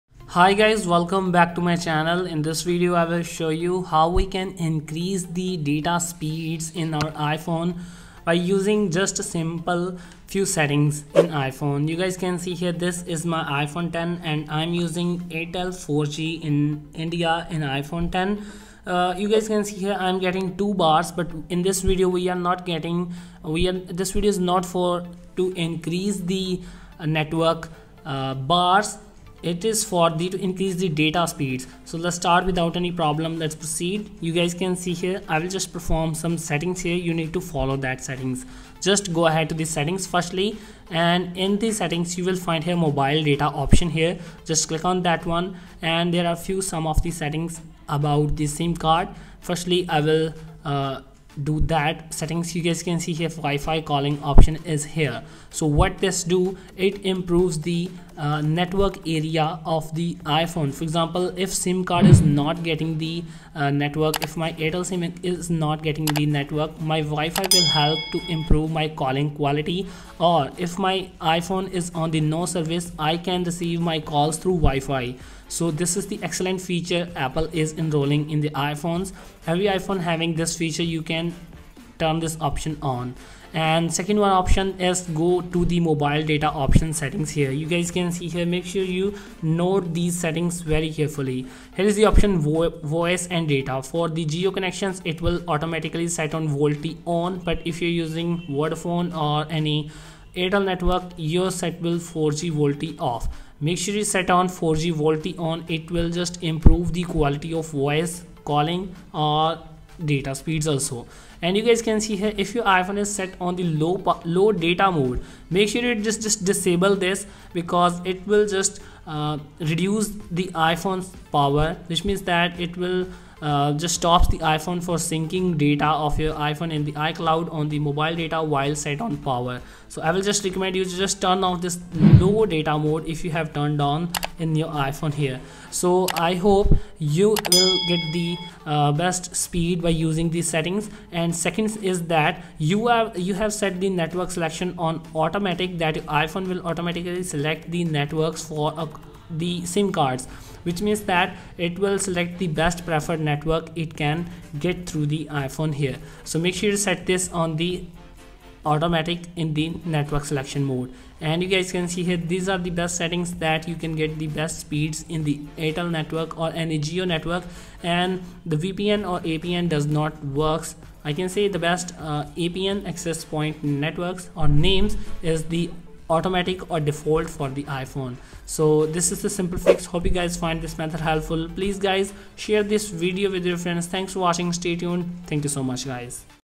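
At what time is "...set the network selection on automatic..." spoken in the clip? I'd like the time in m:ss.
2:23.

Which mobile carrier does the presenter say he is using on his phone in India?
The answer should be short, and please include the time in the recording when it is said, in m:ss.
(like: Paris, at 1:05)
Airtel 4G, at 0:15.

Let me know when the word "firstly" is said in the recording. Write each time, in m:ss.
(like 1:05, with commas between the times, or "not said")
0:40, 0:49.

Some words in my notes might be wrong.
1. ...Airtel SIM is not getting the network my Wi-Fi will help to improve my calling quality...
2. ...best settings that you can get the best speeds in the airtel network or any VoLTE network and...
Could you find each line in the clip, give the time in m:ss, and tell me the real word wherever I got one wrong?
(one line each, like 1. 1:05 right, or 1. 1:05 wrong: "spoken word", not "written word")
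1. 1:04 right
2. 2:42 wrong: "Jio", not "VoLTE".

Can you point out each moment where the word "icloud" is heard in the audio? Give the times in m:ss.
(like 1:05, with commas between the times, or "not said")
2:06.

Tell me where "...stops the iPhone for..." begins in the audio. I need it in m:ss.
2:03.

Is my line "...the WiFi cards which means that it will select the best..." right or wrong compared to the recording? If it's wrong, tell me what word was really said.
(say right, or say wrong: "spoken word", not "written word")
wrong: "SIM", not "WiFi".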